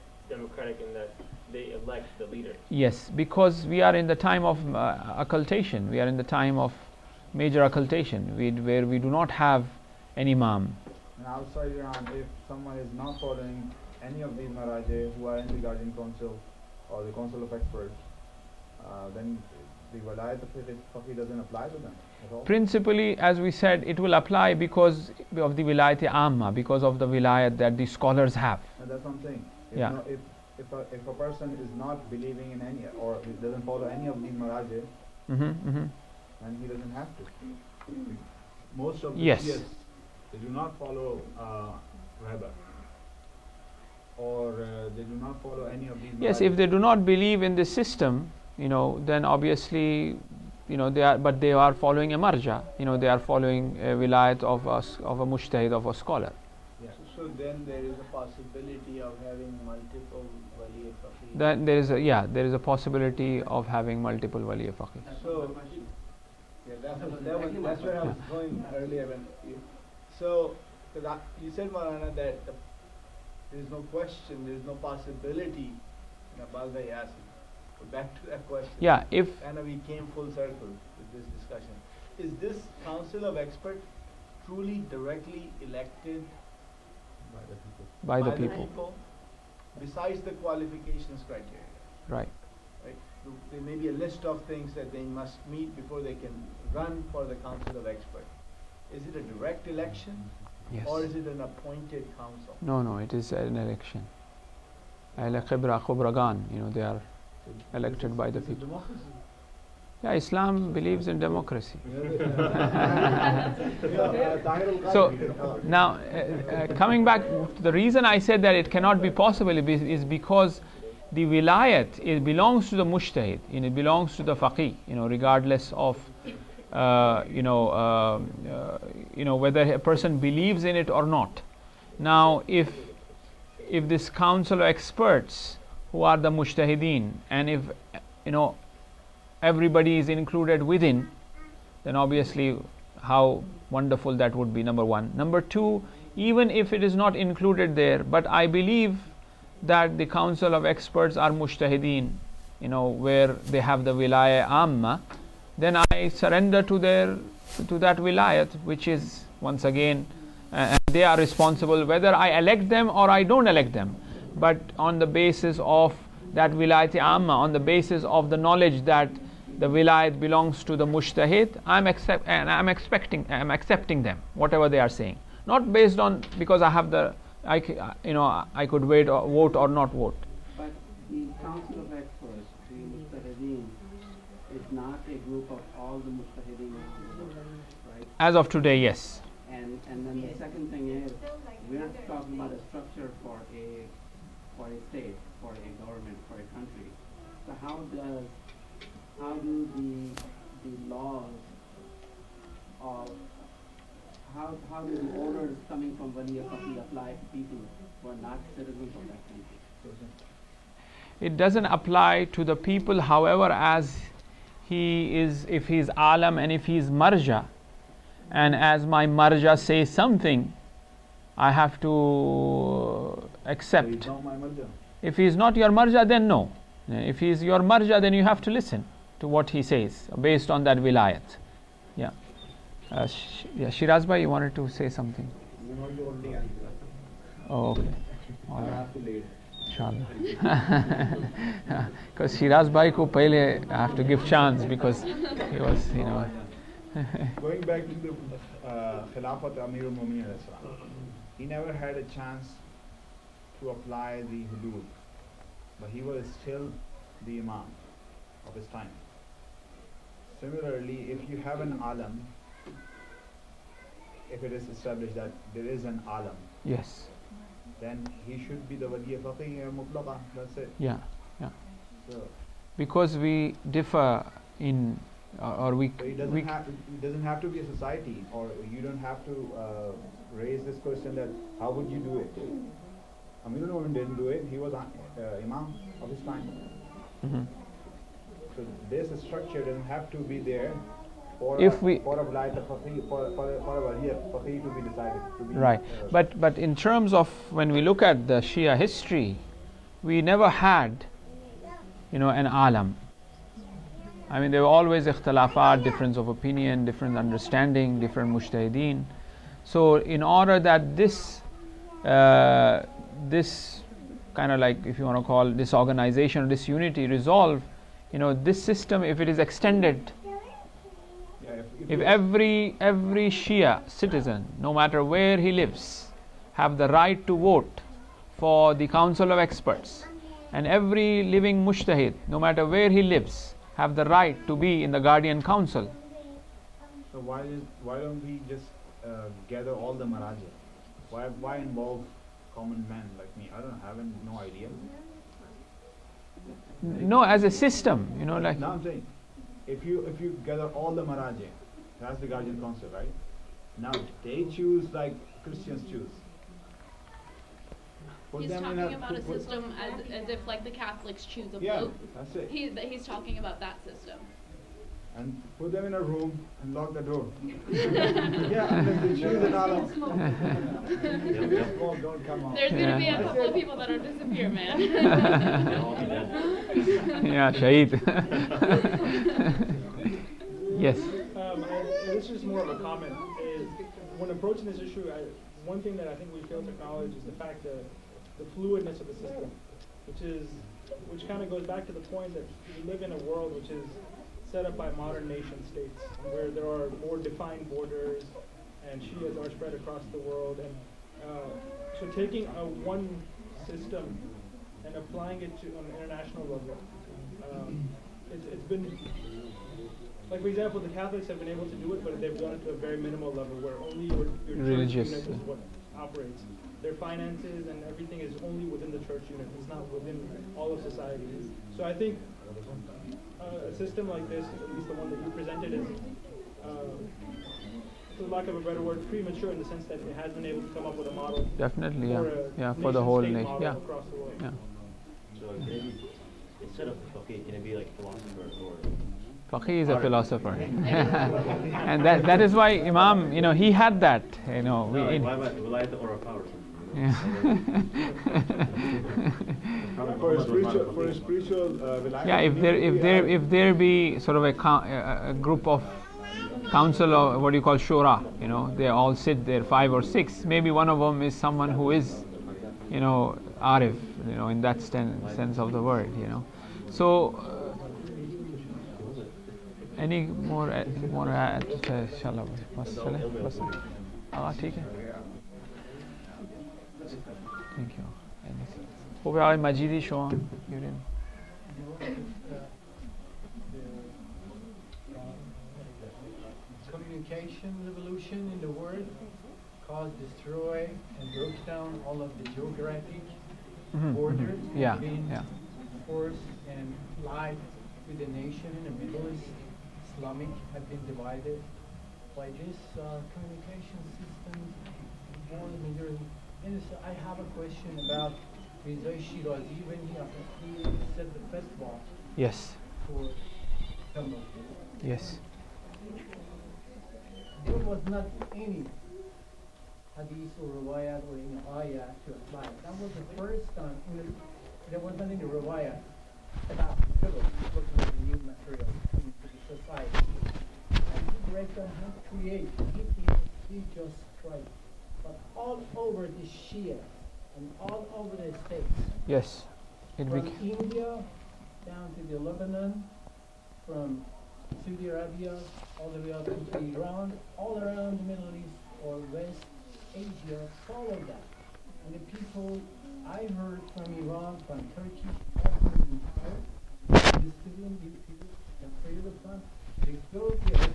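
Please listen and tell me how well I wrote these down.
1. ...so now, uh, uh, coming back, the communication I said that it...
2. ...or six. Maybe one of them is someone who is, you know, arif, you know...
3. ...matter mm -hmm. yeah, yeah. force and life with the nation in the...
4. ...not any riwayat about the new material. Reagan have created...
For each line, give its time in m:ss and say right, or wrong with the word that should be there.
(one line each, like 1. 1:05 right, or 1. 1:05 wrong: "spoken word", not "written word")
1. 1:54 wrong: "reason", not "communication"
2. 7:39 right
3. 8:14 wrong: "border", not "matter"
4. 8:45 right.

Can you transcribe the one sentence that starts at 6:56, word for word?
Their finances and everything is only within the church unit.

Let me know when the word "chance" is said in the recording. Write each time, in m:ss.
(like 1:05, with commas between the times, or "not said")
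4:04, 4:12.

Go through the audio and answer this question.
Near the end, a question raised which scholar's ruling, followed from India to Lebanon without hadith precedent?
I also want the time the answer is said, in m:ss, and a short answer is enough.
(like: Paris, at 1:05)
Shirazi, at 8:28.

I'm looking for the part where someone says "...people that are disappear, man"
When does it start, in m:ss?
6:13.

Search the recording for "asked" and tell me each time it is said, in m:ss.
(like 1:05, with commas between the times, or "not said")
1:16.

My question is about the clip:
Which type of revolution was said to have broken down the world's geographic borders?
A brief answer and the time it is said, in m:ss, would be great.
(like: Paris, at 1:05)
Communication revolution, at 8:06.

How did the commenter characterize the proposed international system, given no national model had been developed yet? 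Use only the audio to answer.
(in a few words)
Premature.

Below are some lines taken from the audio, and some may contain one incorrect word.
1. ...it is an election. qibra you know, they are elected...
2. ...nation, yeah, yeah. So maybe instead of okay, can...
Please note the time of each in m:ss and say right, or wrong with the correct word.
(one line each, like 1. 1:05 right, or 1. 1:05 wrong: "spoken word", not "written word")
1. 1:42 right
2. 7:13 right.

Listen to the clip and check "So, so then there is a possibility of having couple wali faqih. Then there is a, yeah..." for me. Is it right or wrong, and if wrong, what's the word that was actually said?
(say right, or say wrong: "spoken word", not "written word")
wrong: "multiple", not "couple".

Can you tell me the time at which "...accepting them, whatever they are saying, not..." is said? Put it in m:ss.
2:53.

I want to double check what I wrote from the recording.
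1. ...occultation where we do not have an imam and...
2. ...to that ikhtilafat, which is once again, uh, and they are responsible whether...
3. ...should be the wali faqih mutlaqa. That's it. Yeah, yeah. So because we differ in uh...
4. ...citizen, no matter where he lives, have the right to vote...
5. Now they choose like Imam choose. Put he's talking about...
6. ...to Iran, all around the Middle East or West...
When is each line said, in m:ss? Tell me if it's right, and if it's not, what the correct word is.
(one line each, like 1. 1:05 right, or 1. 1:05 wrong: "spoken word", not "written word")
1. 0:07 right
2. 2:37 wrong: "wilayat", not "ikhtilafat"
3. 4:28 right
4. 5:23 right
5. 5:53 wrong: "Christians", not "Imam"
6. 9:06 right.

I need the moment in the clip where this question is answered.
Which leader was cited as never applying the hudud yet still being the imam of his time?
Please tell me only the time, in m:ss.
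4:09.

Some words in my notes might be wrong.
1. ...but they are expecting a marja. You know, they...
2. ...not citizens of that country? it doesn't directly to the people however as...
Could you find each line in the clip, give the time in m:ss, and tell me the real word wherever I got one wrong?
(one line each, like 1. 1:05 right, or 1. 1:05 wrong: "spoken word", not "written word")
1. 0:51 wrong: "following", not "expecting"
2. 3:28 wrong: "apply", not "directly".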